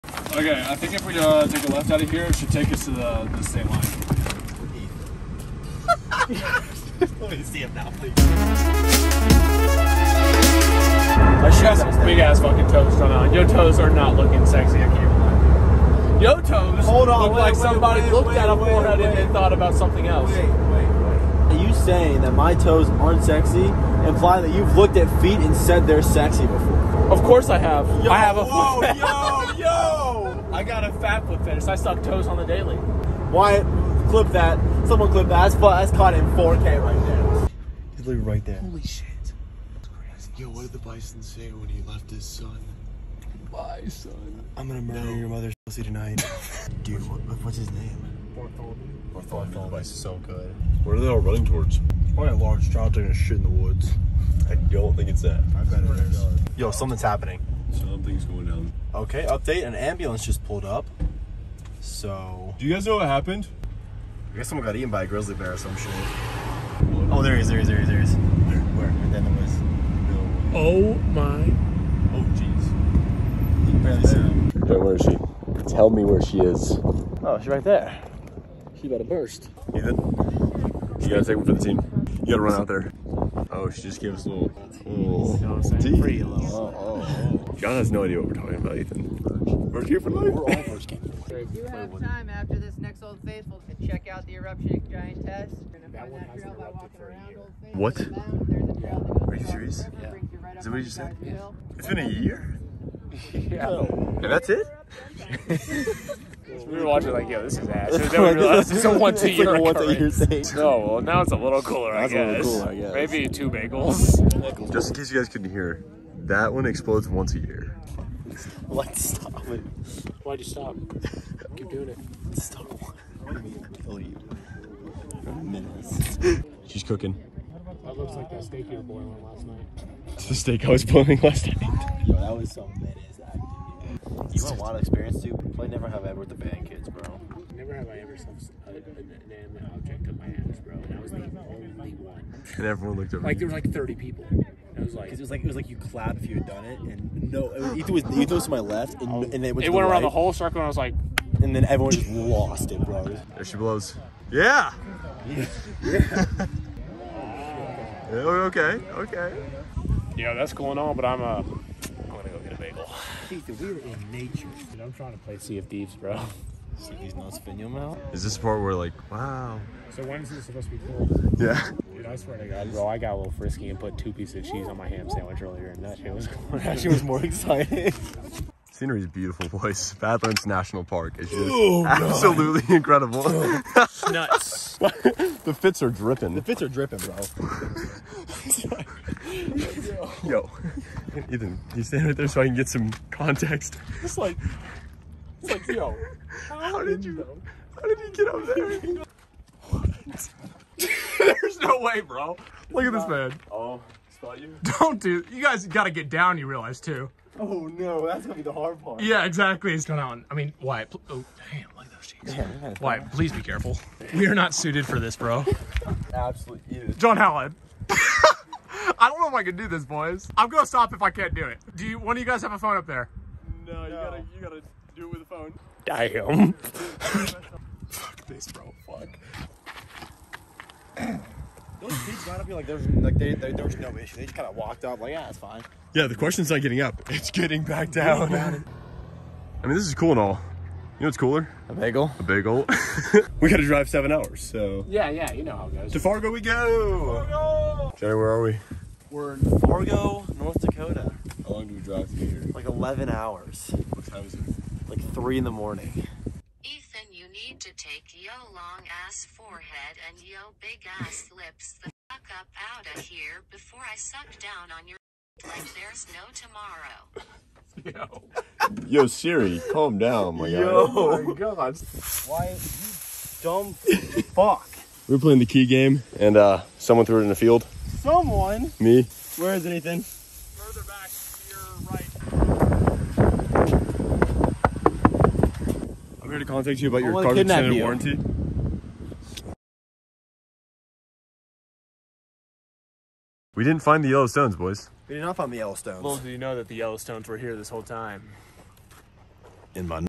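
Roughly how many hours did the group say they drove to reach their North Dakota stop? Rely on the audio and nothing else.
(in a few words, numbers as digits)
11 hours.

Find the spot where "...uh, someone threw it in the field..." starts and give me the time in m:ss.
4:36.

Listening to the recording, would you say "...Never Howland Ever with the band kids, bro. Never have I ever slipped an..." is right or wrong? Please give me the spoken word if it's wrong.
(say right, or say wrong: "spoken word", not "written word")
wrong: "Have", not "Howland".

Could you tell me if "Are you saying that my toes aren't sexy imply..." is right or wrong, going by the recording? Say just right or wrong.
right.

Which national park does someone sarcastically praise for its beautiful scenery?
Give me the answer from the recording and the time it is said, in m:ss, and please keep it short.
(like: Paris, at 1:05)
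Badlands National Park, at 2:59.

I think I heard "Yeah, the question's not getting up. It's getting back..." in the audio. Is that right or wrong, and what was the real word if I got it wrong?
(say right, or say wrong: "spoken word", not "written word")
right.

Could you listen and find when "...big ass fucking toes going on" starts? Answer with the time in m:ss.
0:12.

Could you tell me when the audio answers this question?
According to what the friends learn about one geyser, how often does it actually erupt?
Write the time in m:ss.
1:57.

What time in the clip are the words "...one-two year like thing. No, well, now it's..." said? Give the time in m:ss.
1:48.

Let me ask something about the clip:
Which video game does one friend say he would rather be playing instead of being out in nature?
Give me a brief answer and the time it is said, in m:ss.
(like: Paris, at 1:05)
Sea of Thieves, at 2:45.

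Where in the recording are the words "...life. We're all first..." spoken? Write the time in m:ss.
1:30.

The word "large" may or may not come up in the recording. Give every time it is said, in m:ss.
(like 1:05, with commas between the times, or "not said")
0:52.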